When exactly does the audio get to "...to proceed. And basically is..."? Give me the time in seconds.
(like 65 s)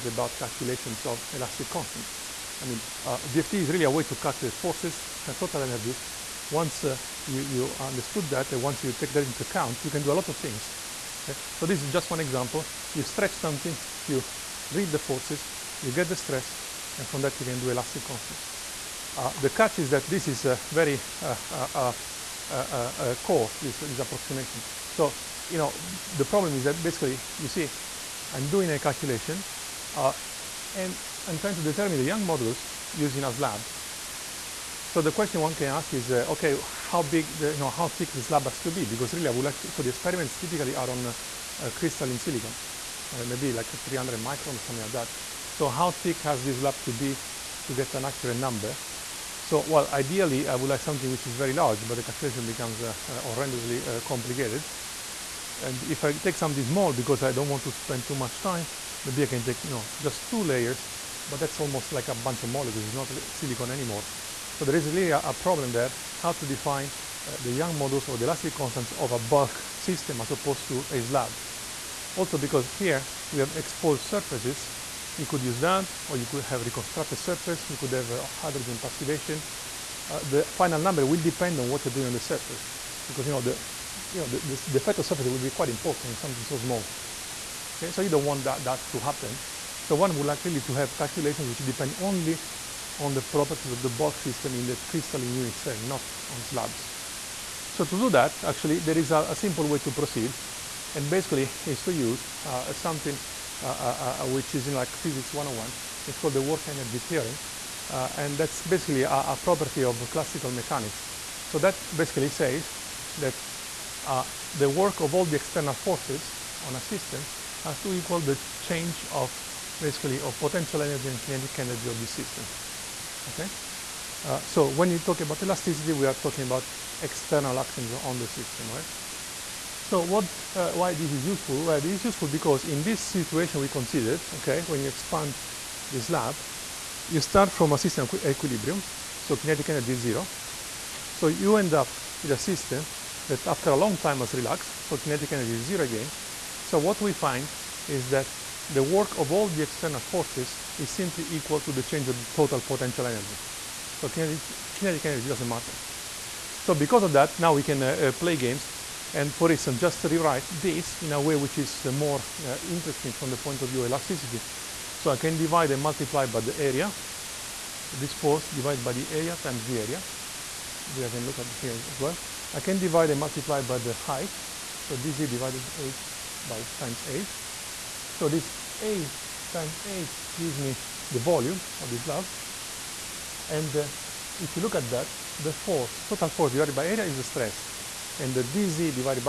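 99 s.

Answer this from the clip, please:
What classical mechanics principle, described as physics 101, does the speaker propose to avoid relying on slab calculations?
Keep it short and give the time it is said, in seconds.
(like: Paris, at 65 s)
work energy theorem, at 106 s.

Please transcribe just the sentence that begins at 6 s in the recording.
Once uh, you, you understood that, and once you take that into account, you can do a lot of things.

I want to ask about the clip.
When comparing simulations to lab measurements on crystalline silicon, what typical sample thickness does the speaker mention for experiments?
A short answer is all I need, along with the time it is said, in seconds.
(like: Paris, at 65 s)
300 microns, at 43 s.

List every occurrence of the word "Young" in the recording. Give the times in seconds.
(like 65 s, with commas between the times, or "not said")
32 s, 67 s.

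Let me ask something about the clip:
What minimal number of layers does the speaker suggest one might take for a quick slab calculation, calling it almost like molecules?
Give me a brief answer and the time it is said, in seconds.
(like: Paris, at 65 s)
2, at 60 s.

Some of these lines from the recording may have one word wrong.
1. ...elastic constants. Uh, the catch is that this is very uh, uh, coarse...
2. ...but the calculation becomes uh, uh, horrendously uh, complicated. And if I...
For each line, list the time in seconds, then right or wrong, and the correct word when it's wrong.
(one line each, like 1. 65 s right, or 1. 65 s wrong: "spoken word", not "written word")
1. 17 s right
2. 51 s right.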